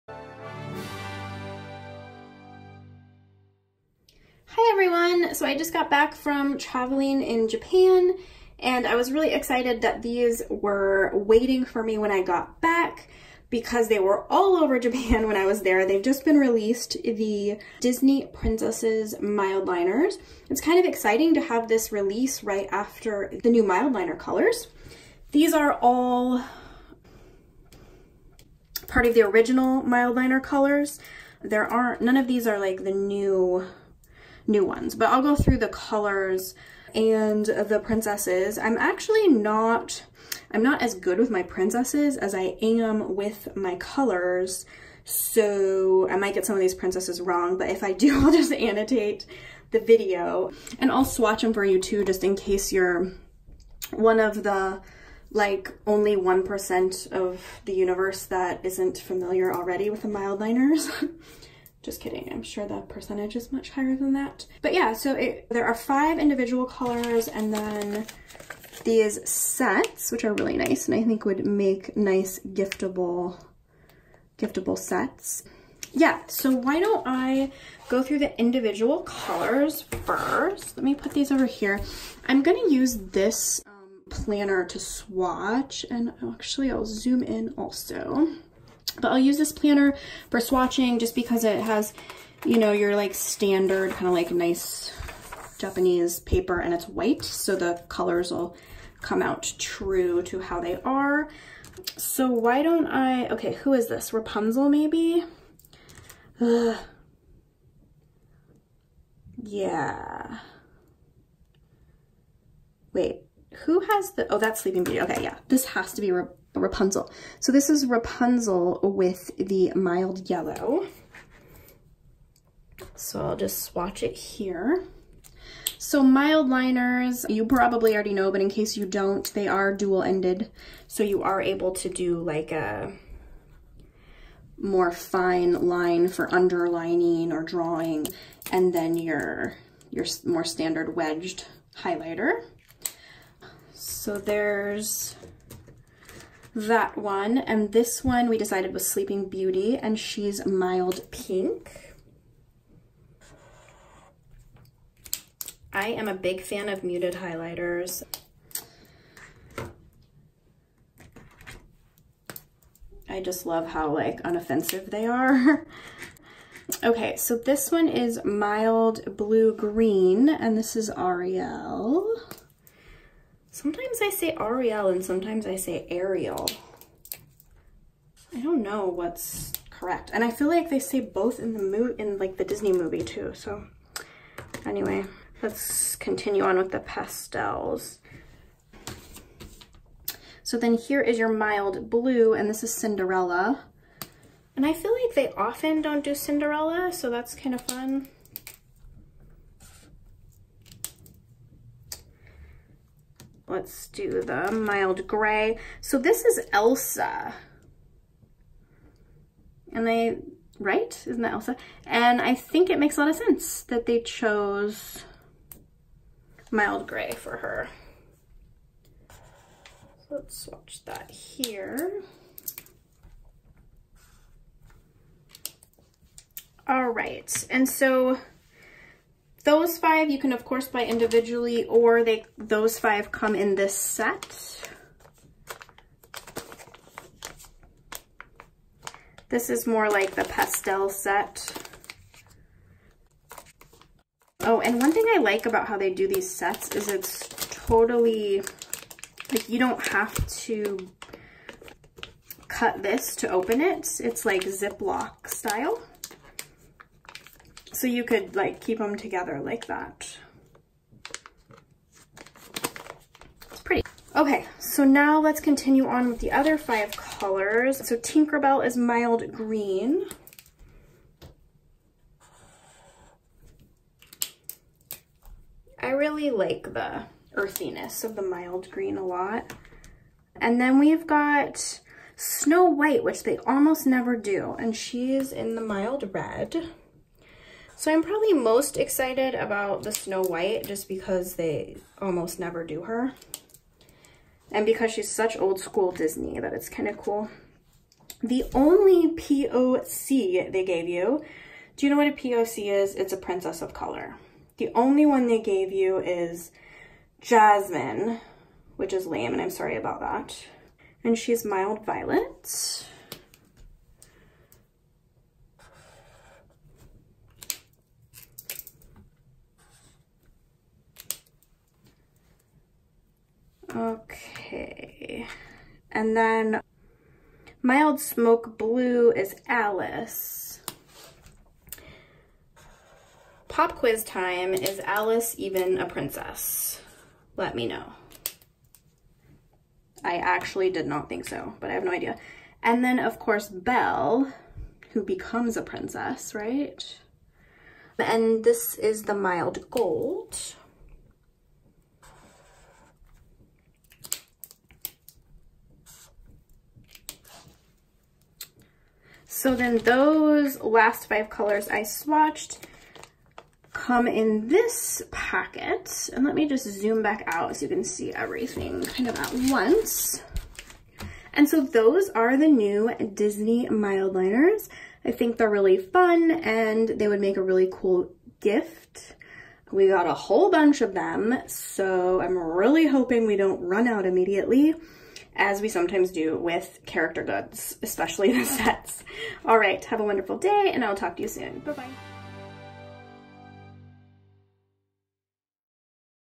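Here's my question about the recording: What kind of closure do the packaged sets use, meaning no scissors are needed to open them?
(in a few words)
Ziploc style.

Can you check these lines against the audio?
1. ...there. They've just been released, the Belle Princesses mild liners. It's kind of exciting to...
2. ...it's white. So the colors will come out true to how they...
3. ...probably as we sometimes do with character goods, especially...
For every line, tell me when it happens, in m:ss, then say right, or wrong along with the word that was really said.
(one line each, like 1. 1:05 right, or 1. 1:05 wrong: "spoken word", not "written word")
1. 0:15 wrong: "Disney", not "Belle"
2. 1:36 right
3. 6:24 wrong: "immediately", not "probably".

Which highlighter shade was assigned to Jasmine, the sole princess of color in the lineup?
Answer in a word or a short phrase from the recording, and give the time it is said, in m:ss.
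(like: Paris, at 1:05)
Mild violet, at 5:11.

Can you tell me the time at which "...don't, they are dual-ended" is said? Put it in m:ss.
2:08.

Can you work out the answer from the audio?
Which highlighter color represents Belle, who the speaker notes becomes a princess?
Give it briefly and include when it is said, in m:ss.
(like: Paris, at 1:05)
Mild gold, at 5:49.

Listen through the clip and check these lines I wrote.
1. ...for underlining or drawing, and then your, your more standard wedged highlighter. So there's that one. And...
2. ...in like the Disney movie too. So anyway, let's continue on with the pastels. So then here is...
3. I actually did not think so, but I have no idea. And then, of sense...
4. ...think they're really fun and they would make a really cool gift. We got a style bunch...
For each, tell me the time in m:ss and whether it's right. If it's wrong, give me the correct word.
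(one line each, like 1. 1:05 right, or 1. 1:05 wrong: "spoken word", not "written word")
1. 2:16 right
2. 3:02 right
3. 5:40 wrong: "course", not "sense"
4. 6:15 wrong: "whole", not "style".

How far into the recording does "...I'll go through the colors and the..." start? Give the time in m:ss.
0:35.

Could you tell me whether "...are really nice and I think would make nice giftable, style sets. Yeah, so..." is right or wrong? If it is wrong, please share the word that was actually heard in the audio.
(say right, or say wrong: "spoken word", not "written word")
wrong: "giftable", not "style".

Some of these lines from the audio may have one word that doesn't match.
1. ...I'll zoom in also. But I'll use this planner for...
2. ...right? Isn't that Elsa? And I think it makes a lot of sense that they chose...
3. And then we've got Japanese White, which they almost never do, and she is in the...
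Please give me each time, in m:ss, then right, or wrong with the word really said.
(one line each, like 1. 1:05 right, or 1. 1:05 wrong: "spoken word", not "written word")
1. 1:26 right
2. 3:30 right
3. 4:40 wrong: "Snow", not "Japanese".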